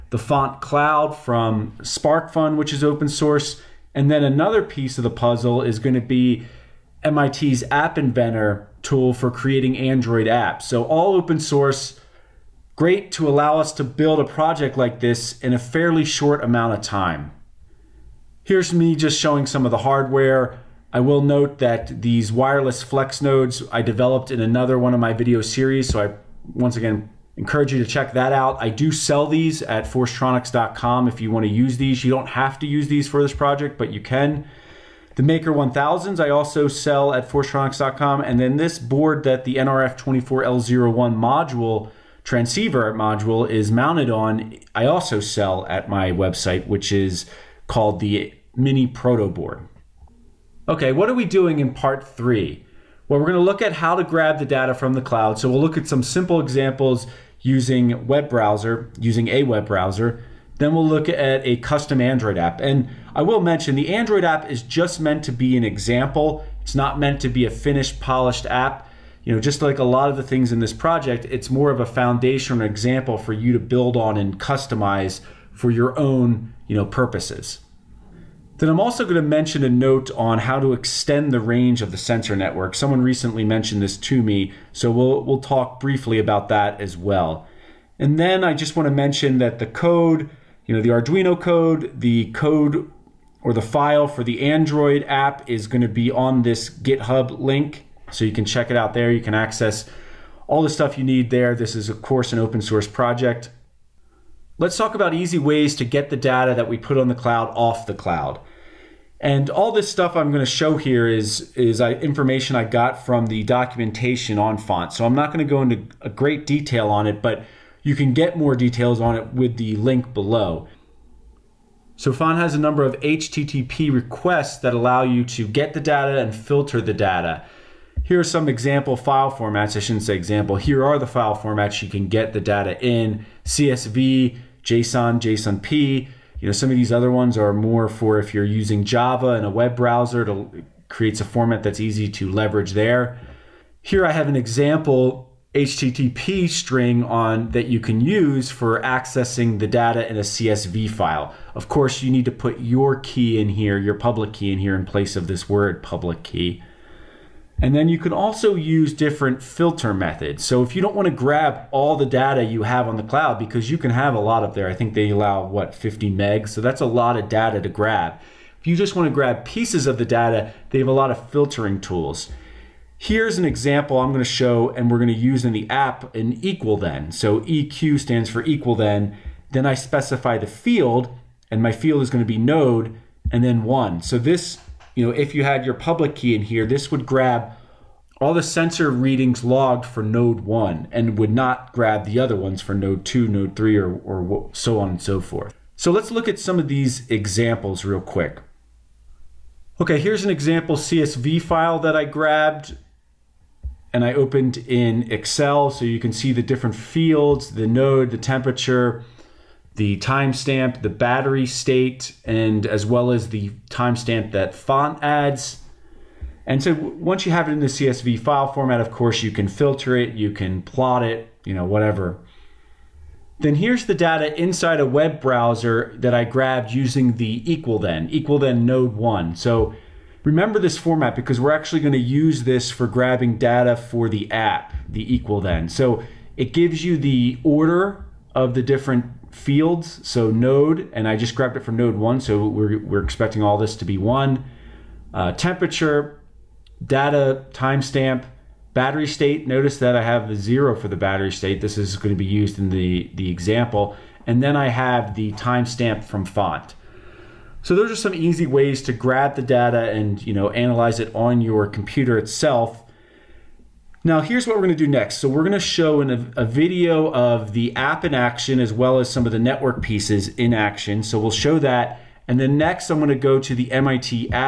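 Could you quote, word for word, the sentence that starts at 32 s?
You don't have to use these for this project, but you can.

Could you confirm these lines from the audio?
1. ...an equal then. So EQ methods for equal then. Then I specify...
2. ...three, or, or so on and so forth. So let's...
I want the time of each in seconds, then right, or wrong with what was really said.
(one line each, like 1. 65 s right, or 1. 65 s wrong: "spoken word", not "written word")
1. 176 s wrong: "stands", not "methods"
2. 193 s right.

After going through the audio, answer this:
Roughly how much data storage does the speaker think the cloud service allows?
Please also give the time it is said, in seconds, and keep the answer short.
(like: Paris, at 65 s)
50 megs, at 165 s.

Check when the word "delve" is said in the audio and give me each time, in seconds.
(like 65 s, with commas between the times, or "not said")
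not said.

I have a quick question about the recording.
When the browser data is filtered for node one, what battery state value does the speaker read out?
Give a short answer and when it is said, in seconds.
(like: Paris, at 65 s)
0, at 250 s.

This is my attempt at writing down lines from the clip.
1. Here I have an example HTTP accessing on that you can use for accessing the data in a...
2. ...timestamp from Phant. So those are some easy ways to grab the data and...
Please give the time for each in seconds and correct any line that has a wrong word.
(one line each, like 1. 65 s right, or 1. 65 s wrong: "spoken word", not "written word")
1. 143 s wrong: "string", not "accessing"
2. 255 s right.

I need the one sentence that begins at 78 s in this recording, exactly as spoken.
Then I'm also going to mention a note on how to extend the range of the sensor network.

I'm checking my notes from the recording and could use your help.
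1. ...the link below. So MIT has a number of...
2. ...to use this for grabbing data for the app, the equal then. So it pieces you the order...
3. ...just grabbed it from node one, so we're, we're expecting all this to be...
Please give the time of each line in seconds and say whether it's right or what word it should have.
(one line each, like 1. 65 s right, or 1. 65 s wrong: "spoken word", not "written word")
1. 119 s wrong: "Phant", not "MIT"
2. 231 s wrong: "gives", not "pieces"
3. 241 s right.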